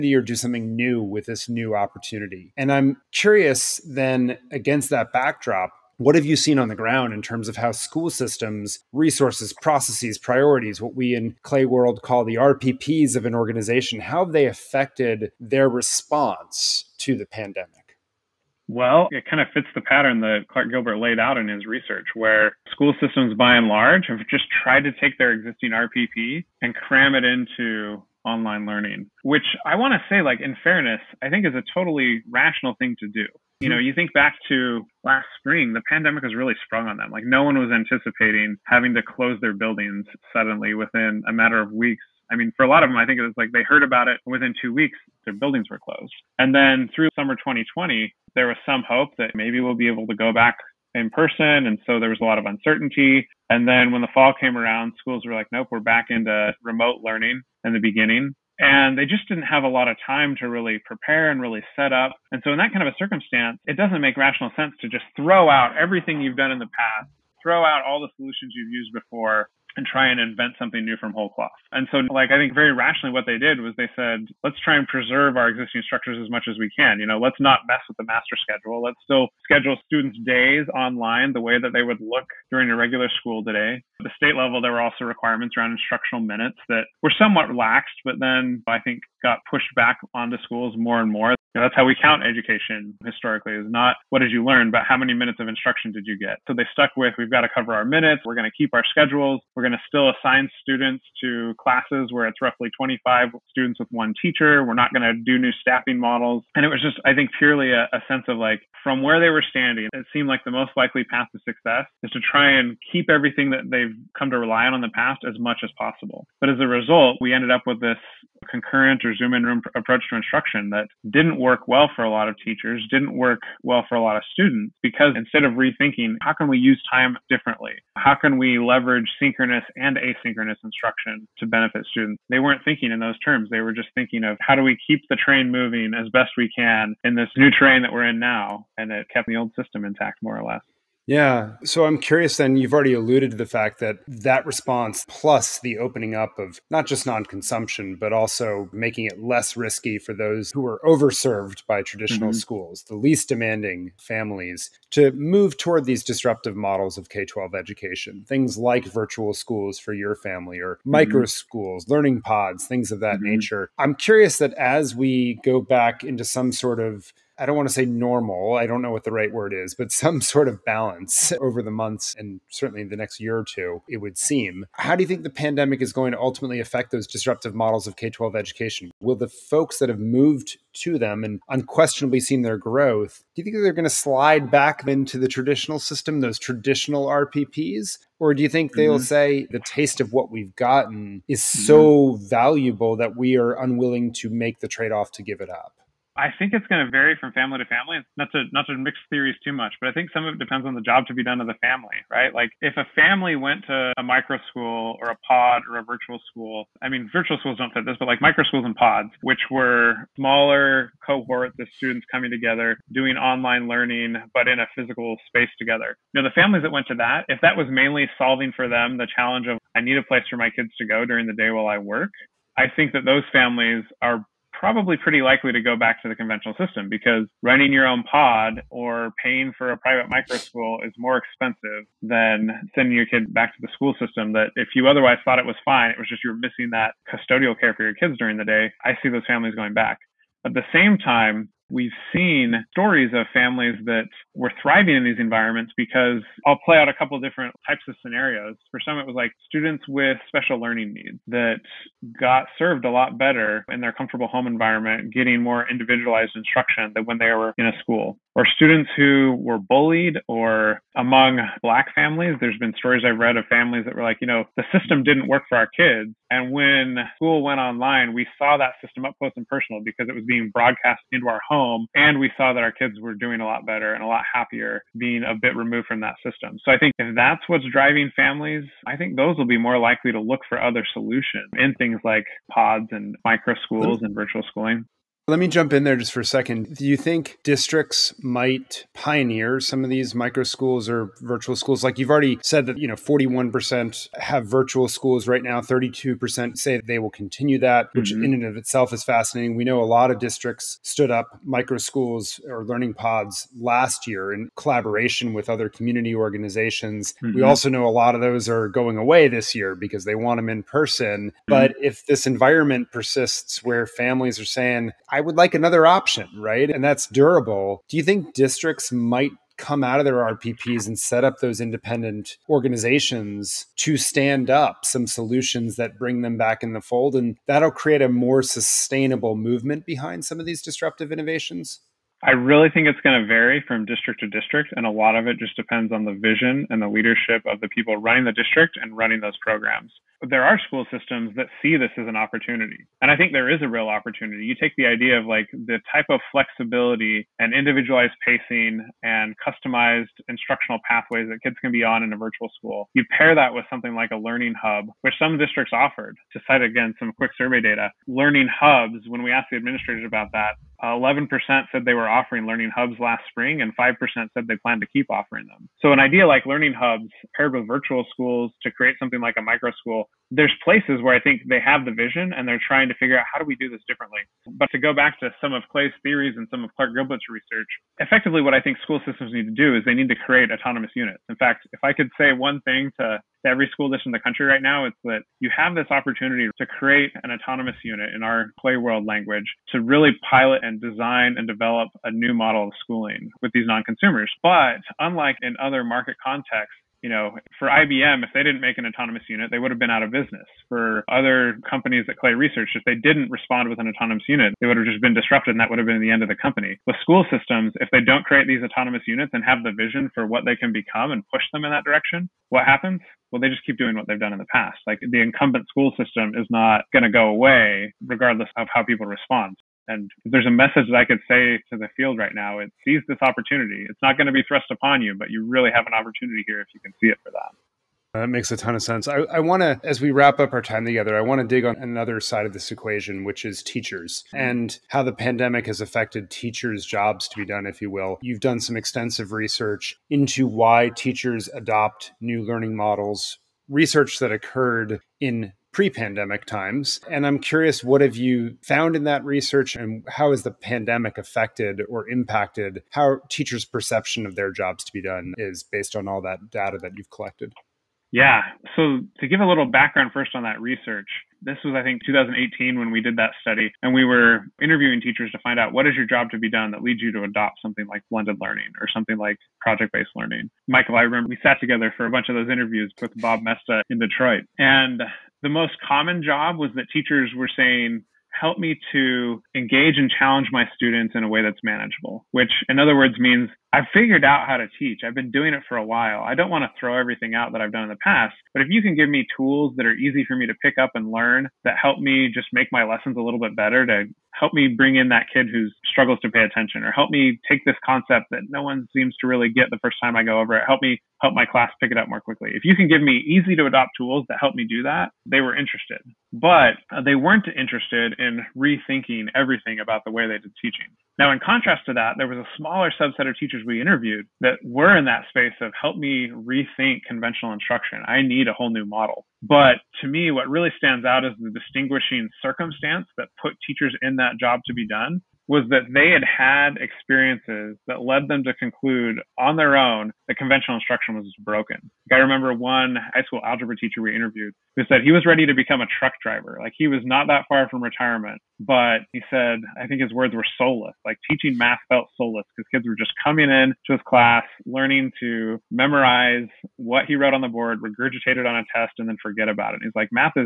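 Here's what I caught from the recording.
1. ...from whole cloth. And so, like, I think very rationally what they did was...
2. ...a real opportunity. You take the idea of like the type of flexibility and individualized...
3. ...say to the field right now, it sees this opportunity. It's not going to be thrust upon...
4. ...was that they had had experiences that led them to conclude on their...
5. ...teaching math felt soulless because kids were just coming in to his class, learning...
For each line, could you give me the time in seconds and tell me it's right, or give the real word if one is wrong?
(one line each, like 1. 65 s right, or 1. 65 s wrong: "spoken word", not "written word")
1. 70 s right
2. 343 s right
3. 421 s right
4. 525 s right
5. 541 s right.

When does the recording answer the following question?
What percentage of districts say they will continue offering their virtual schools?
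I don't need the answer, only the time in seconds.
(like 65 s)
295 s.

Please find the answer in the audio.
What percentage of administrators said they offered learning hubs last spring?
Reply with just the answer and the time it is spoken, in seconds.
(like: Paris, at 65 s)
11%, at 360 s.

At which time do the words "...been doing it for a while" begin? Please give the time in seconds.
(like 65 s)
485 s.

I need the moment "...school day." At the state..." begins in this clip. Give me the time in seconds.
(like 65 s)
83 s.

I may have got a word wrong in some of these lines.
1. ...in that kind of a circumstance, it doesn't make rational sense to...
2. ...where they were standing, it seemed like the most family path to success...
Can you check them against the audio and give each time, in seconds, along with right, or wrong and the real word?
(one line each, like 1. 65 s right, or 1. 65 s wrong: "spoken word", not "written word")
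1. 62 s right
2. 109 s wrong: "likely", not "family".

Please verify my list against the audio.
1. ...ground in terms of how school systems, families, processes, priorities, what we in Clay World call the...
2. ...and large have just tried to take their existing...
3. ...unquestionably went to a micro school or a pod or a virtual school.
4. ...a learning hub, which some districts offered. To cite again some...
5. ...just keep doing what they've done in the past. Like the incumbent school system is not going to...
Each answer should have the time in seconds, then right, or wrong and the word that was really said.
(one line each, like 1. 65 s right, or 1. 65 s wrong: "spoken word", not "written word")
1. 6 s wrong: "resources", not "families"
2. 23 s right
3. 202 s wrong: "family", not "unquestionably"
4. 354 s right
5. 413 s right.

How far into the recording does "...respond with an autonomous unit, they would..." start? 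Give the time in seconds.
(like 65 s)
403 s.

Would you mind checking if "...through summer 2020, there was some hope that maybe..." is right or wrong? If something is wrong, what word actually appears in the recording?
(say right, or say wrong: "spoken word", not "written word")
right.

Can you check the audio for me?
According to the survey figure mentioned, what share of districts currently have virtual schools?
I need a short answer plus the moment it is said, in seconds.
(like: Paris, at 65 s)
41%, at 292 s.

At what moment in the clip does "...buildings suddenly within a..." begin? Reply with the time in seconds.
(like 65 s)
39 s.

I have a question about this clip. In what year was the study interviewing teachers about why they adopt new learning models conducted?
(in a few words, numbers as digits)
2018.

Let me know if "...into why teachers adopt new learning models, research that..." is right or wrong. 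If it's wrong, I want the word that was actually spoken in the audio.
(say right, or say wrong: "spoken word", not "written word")
right.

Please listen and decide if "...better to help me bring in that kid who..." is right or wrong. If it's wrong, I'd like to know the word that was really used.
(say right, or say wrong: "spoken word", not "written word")
right.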